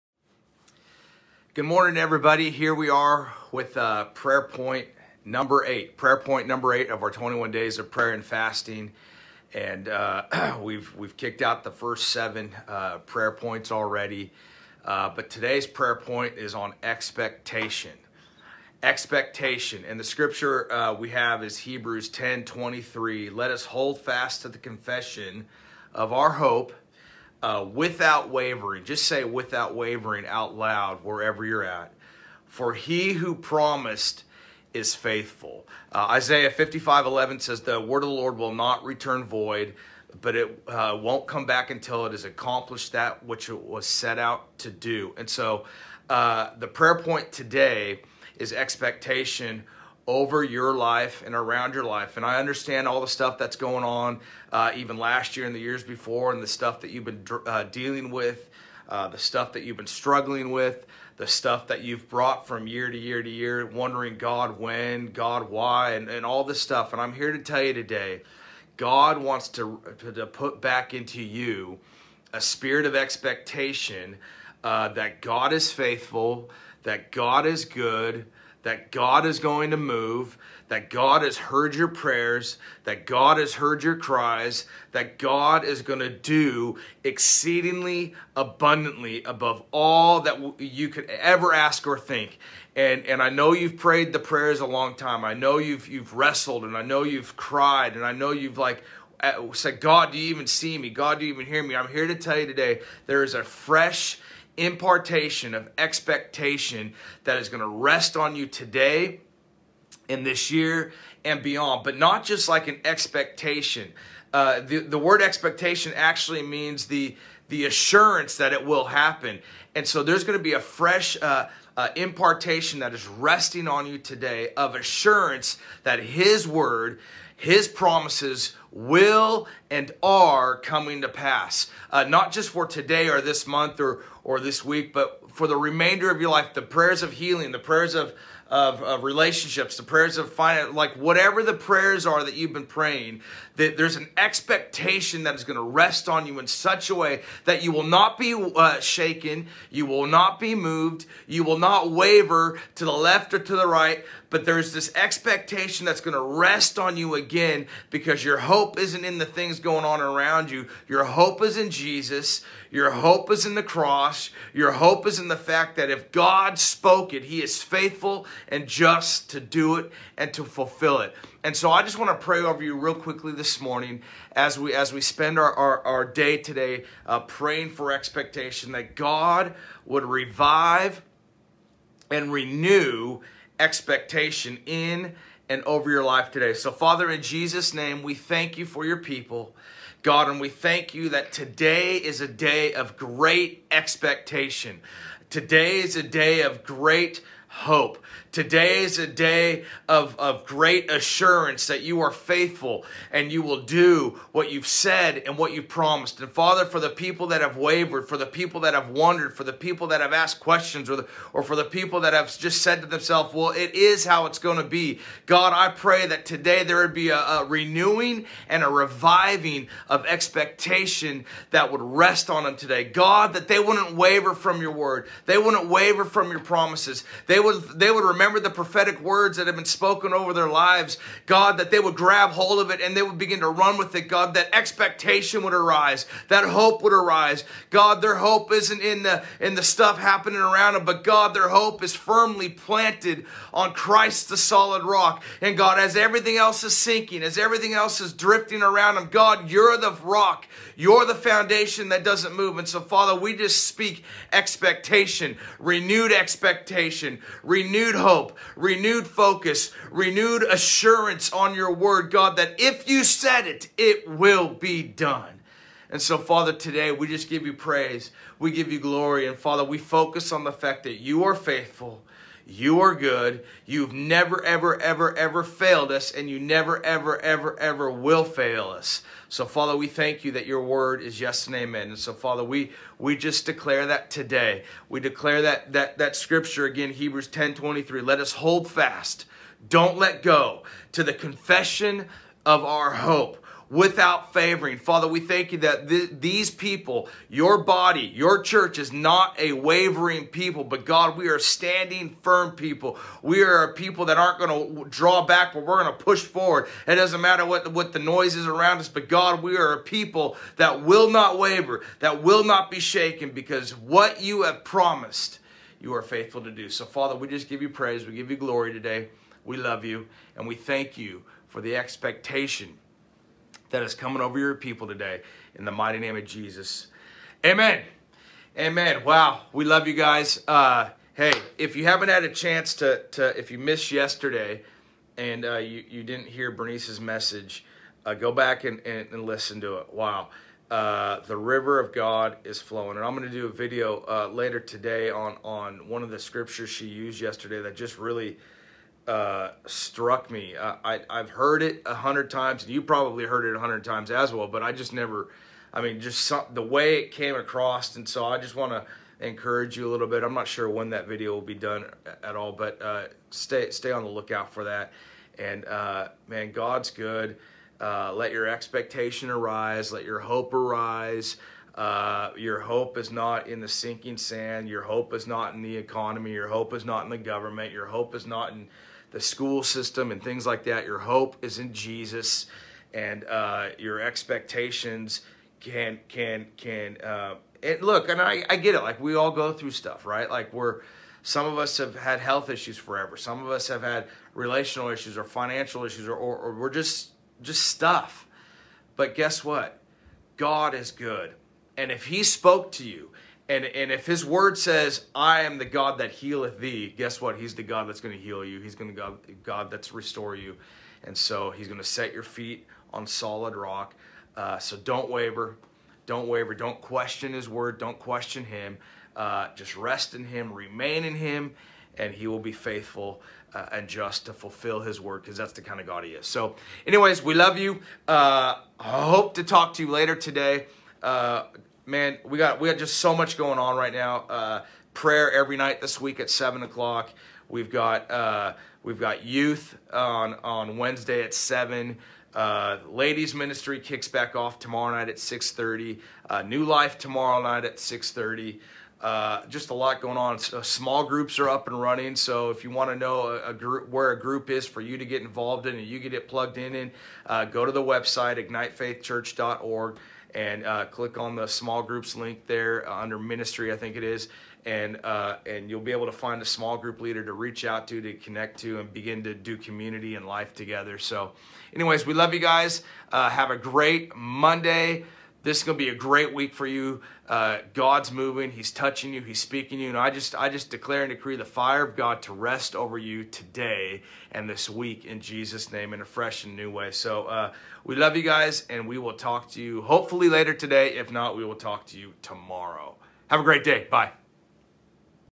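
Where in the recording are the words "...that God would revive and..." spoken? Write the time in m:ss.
2:58.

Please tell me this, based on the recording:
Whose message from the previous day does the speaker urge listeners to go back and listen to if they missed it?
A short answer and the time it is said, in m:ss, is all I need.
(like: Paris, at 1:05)
Bernice, at 5:36.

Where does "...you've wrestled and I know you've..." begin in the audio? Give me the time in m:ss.
1:35.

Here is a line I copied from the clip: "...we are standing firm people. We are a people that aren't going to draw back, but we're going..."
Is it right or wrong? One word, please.
right.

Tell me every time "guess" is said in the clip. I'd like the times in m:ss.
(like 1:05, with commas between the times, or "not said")
6:39, 6:46.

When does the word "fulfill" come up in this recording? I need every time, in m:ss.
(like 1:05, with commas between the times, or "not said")
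2:50, 7:04.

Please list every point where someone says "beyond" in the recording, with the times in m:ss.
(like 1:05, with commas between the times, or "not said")
1:51.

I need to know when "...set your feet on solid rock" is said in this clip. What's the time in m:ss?
6:51.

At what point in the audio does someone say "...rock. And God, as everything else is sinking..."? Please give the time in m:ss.
4:04.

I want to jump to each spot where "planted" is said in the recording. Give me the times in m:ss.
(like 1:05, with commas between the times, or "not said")
4:02.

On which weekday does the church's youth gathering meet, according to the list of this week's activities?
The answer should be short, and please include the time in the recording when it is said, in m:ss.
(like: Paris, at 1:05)
Wednesday, at 7:20.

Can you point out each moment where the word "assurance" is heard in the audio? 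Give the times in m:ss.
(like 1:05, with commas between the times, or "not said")
1:57, 2:04, 3:20, 4:20.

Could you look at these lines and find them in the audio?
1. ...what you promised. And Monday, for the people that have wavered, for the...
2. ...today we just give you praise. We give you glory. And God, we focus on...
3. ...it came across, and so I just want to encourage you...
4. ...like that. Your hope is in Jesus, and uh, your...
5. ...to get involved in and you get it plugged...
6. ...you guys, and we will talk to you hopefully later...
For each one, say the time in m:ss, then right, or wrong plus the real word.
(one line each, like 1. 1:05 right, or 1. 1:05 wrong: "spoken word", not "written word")
1. 3:25 wrong: "Father", not "Monday"
2. 4:26 wrong: "Father", not "God"
3. 5:56 right
4. 6:20 right
5. 7:34 right
6. 8:08 right.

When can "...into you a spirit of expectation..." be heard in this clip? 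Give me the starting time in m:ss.
1:10.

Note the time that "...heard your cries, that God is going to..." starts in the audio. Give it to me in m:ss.
1:23.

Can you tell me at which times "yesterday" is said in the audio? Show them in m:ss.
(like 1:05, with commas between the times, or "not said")
5:33, 5:47.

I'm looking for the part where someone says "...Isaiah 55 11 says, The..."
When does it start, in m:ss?
0:36.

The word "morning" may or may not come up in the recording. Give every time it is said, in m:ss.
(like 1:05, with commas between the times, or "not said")
0:01, 2:53.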